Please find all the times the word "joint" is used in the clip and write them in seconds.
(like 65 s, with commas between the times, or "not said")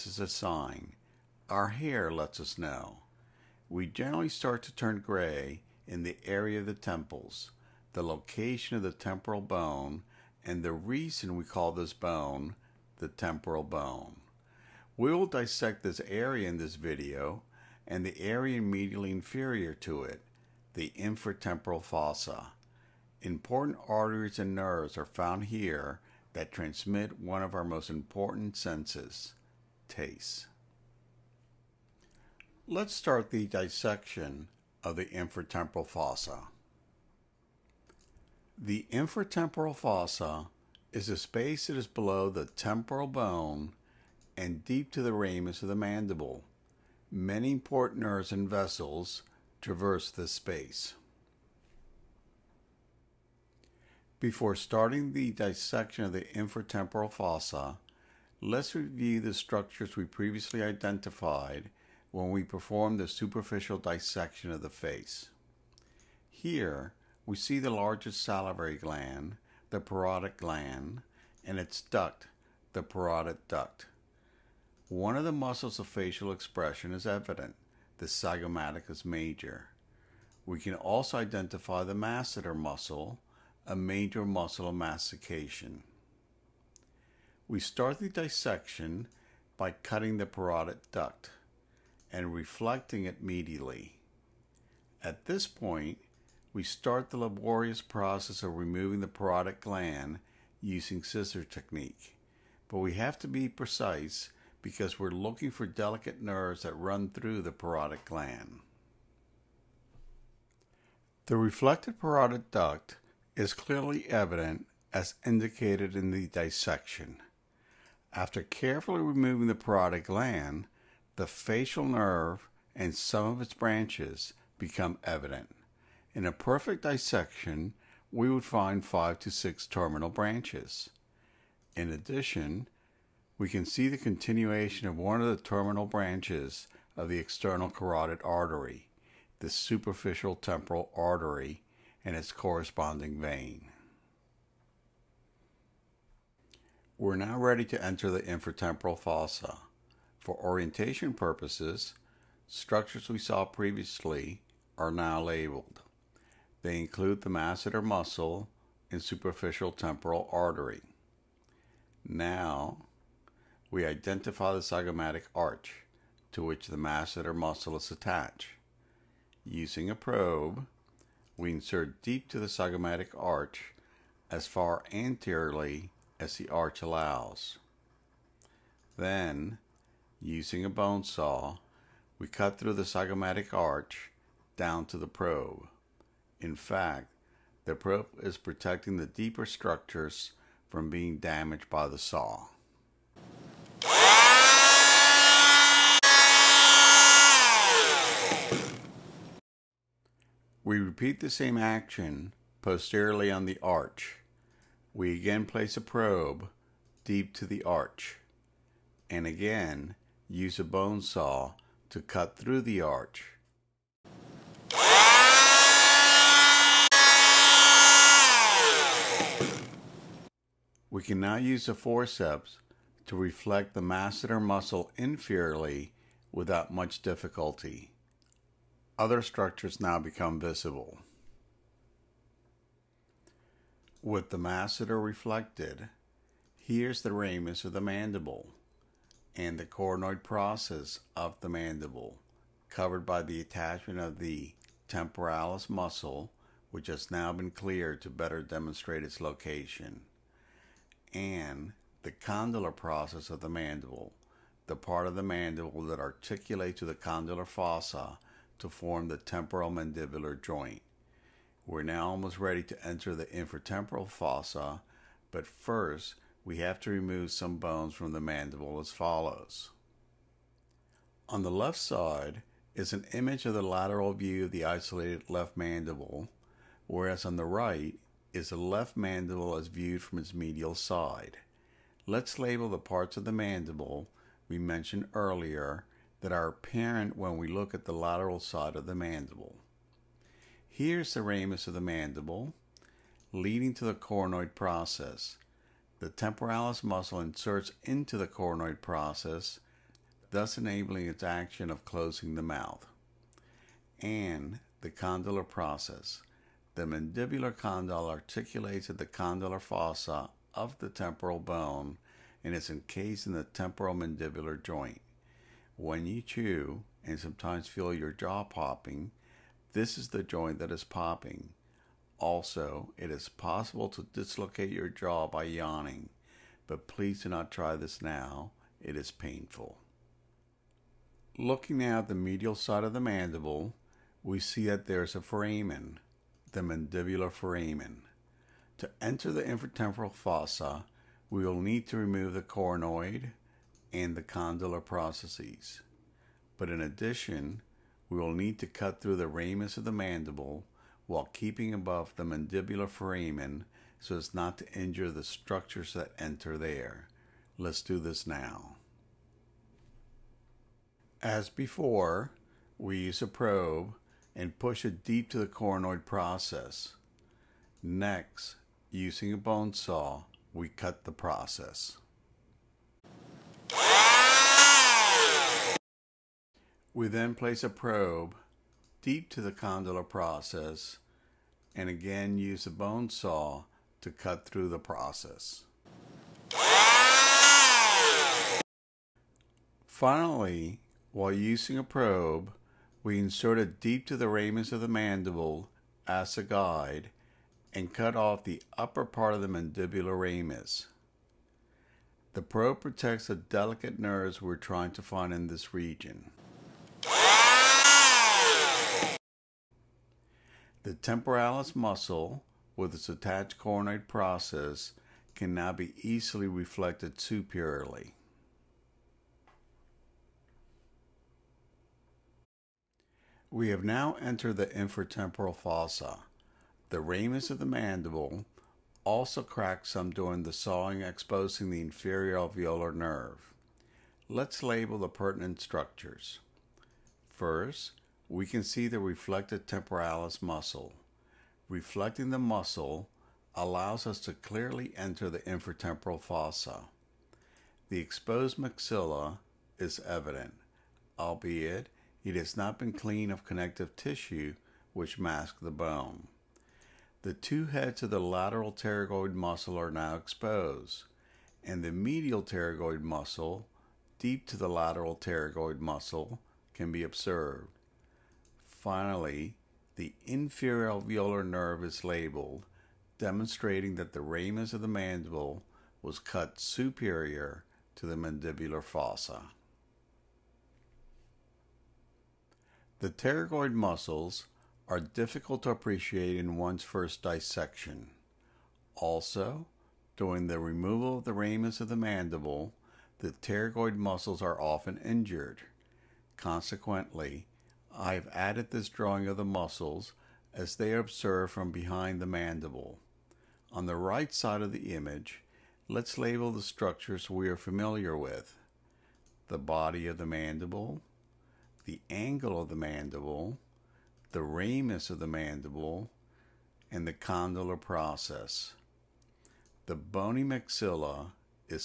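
260 s, 314 s, 320 s.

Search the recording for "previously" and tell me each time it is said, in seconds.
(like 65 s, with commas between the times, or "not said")
60 s, 153 s.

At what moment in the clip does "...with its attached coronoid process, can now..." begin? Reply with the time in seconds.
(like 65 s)
412 s.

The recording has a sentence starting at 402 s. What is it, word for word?
The probe protects the delicate nerves we're trying to find in this region.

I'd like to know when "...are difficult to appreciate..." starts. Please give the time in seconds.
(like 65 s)
484 s.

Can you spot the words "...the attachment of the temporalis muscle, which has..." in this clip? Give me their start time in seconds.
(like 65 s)
243 s.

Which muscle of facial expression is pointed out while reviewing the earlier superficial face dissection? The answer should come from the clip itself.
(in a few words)
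Zygomaticus major.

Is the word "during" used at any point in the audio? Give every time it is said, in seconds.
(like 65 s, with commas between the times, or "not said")
430 s, 490 s.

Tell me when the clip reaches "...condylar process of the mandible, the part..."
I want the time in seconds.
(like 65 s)
252 s.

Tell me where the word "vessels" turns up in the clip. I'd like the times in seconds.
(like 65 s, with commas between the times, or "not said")
48 s.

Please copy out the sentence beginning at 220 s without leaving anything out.
We can now use the forceps to reflect the masseter muscle inferiorly without much difficulty.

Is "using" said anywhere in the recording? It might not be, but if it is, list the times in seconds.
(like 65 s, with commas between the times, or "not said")
100 s, 169 s, 180 s, 368 s, 391 s.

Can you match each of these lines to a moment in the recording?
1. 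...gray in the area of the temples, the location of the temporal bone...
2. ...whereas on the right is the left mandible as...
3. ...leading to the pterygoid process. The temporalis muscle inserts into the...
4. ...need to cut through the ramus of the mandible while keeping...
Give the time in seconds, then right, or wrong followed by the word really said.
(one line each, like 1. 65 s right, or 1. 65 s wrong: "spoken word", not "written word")
1. 5 s right
2. 276 s right
3. 293 s wrong: "coronoid", not "pterygoid"
4. 348 s right.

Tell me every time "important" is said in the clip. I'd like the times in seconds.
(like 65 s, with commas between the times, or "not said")
23 s, 27 s, 47 s.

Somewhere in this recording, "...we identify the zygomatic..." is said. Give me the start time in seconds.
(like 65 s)
163 s.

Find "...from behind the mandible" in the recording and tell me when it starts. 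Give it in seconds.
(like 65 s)
501 s.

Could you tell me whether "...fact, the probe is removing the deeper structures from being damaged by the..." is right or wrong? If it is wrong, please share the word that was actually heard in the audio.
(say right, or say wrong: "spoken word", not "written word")
wrong: "protecting", not "removing".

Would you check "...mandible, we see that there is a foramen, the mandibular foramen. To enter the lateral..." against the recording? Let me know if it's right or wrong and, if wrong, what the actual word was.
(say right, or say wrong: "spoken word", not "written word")
wrong: "infratemporal", not "lateral".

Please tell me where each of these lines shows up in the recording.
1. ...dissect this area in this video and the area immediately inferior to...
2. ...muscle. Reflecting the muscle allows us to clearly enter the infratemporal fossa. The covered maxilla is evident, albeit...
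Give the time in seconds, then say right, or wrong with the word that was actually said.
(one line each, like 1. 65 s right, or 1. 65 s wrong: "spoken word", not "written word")
1. 15 s right
2. 440 s wrong: "exposed", not "covered".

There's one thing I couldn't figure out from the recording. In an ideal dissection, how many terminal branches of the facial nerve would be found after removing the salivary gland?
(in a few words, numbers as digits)
5 to 6.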